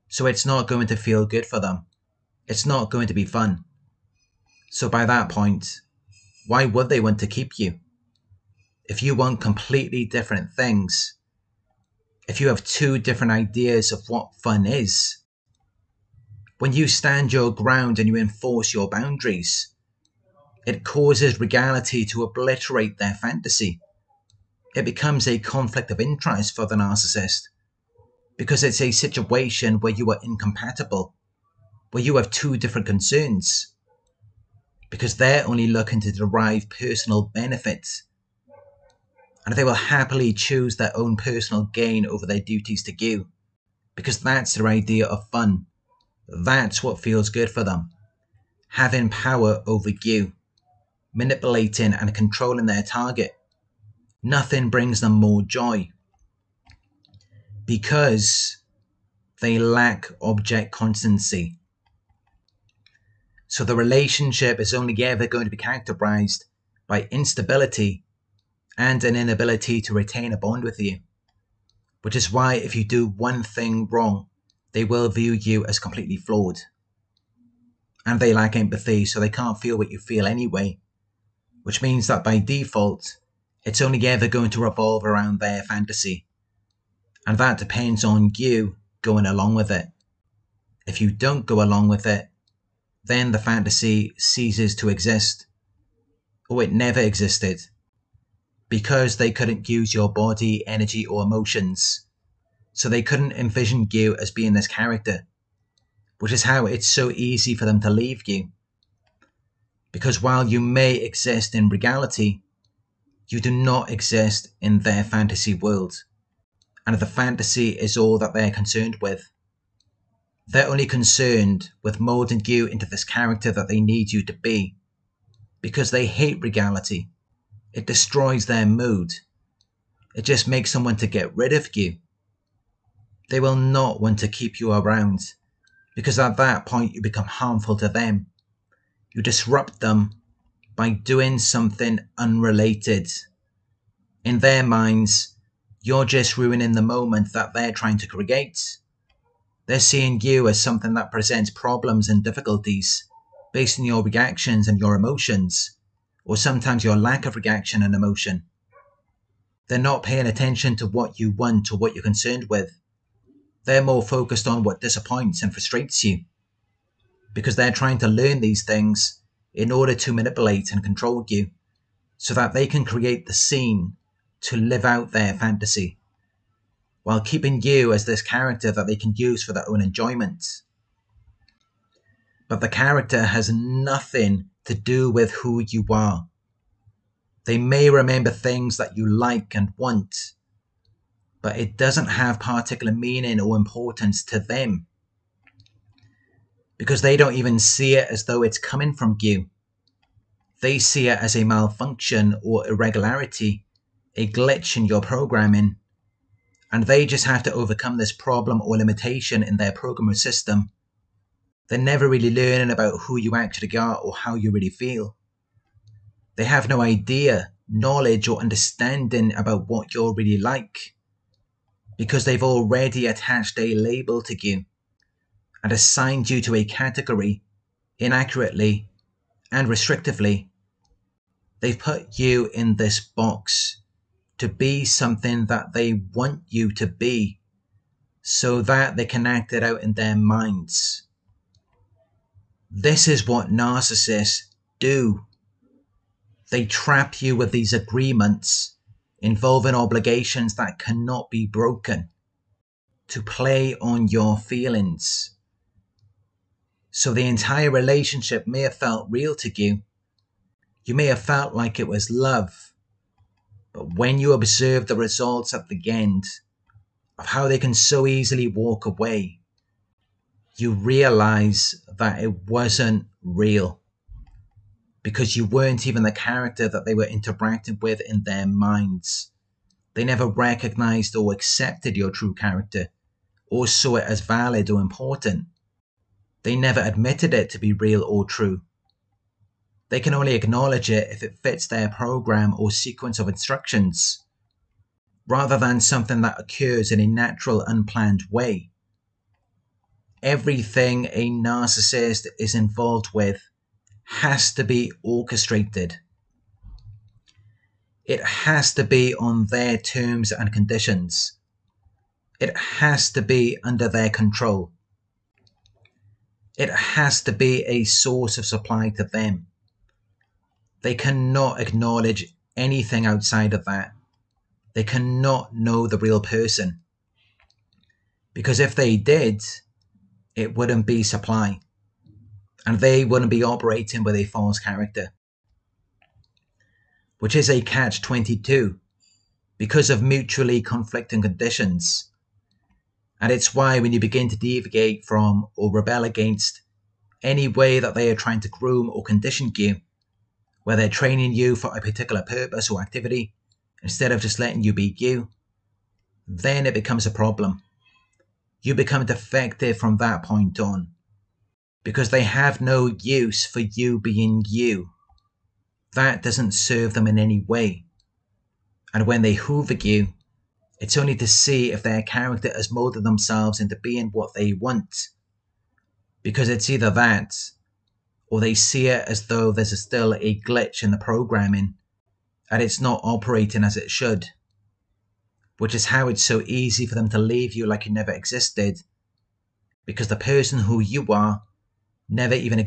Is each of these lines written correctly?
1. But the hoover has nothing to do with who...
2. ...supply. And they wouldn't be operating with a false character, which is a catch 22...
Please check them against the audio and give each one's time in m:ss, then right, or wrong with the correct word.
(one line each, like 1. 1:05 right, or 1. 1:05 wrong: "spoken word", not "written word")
1. 3:02 wrong: "character", not "hoover"
2. 5:31 right.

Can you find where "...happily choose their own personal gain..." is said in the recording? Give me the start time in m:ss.
0:39.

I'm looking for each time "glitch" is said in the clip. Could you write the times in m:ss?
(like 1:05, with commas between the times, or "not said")
3:24, 6:20.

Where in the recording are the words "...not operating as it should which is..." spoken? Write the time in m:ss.
6:22.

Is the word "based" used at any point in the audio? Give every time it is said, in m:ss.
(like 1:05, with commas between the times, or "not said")
2:33.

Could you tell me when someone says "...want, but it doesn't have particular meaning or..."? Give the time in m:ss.
3:09.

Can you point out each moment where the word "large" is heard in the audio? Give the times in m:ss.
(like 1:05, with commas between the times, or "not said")
not said.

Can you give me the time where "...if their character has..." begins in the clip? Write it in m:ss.
6:11.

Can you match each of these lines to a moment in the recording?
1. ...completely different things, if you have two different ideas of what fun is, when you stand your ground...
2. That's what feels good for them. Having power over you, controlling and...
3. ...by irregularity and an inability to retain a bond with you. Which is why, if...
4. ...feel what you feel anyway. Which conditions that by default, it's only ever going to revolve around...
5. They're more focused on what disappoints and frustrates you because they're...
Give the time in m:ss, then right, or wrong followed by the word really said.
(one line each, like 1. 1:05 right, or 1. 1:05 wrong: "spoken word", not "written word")
1. 0:09 right
2. 0:46 wrong: "manipulating", not "controlling"
3. 1:06 wrong: "instability", not "irregularity"
4. 1:19 wrong: "means", not "conditions"
5. 2:43 right.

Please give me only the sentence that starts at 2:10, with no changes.
It just makes someone to get rid of you.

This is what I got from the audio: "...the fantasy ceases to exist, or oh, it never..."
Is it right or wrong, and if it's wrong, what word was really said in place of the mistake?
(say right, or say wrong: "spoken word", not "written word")
right.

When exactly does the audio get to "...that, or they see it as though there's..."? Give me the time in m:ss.
6:16.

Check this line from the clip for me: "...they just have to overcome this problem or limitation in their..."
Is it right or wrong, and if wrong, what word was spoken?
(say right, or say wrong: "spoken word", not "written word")
right.